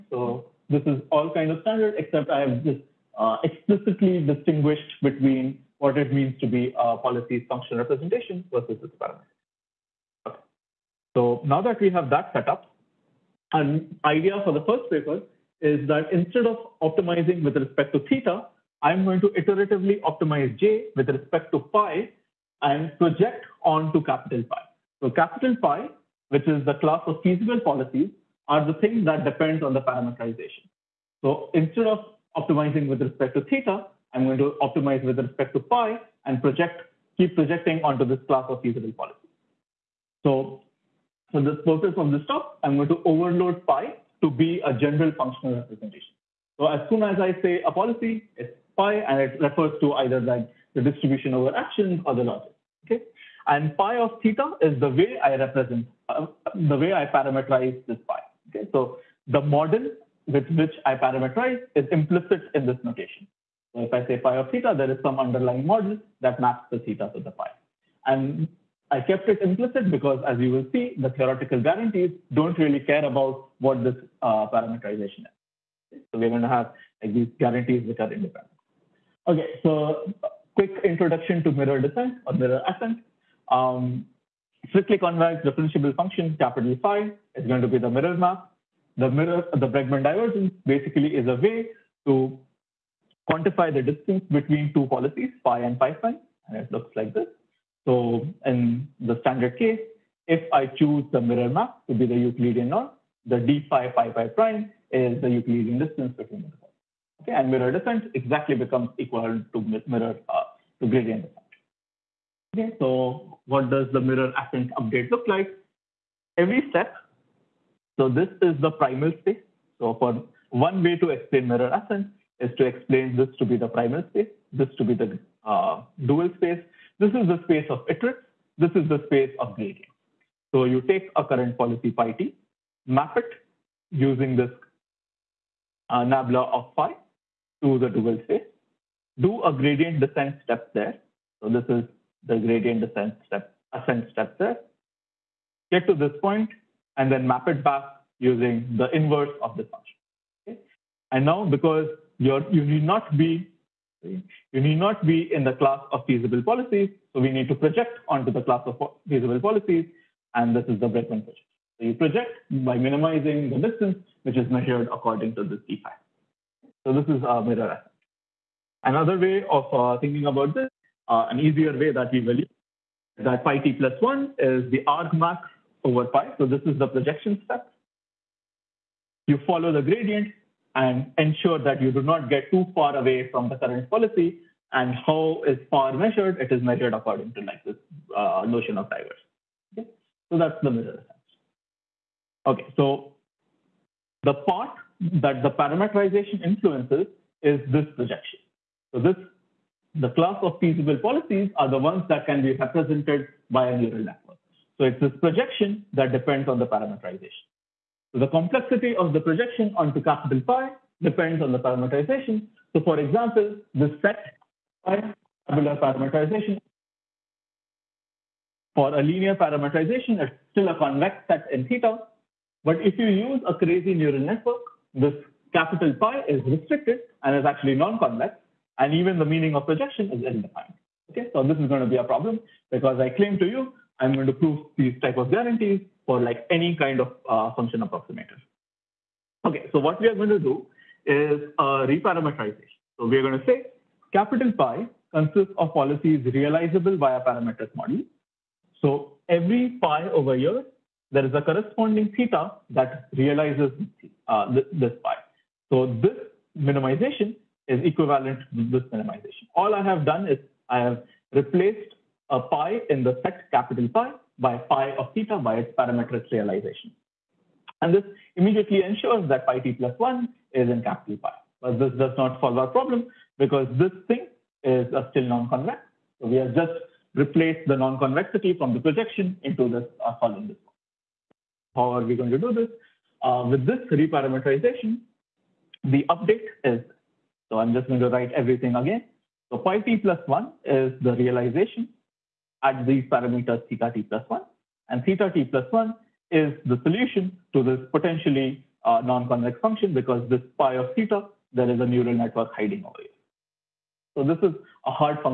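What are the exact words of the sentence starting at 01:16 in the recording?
So we're going to have like, these guarantees which are independent.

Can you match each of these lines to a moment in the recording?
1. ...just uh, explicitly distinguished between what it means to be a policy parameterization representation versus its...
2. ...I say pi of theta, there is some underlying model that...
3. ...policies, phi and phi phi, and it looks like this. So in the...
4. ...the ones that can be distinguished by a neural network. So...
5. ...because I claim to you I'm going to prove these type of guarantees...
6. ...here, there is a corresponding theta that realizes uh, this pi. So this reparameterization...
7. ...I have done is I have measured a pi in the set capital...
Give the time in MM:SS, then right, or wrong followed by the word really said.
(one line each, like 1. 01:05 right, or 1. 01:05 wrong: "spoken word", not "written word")
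1. 00:02 wrong: "function", not "parameterization"
2. 01:03 right
3. 01:34 right
4. 03:21 wrong: "represented", not "distinguished"
5. 03:52 right
6. 04:10 wrong: "minimization", not "reparameterization"
7. 04:19 wrong: "replaced", not "measured".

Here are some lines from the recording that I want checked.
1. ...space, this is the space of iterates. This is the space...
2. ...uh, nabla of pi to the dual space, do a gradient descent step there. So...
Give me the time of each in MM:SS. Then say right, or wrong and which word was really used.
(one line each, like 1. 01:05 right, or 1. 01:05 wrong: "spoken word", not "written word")
1. 02:06 right
2. 02:15 right.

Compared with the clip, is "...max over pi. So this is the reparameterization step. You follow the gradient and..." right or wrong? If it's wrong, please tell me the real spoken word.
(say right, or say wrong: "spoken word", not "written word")
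wrong: "projection", not "reparameterization".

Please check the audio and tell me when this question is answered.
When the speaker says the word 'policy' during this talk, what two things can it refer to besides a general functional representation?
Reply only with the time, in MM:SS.
00:50.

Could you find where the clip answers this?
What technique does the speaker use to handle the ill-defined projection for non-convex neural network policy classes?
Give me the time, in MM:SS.
04:01.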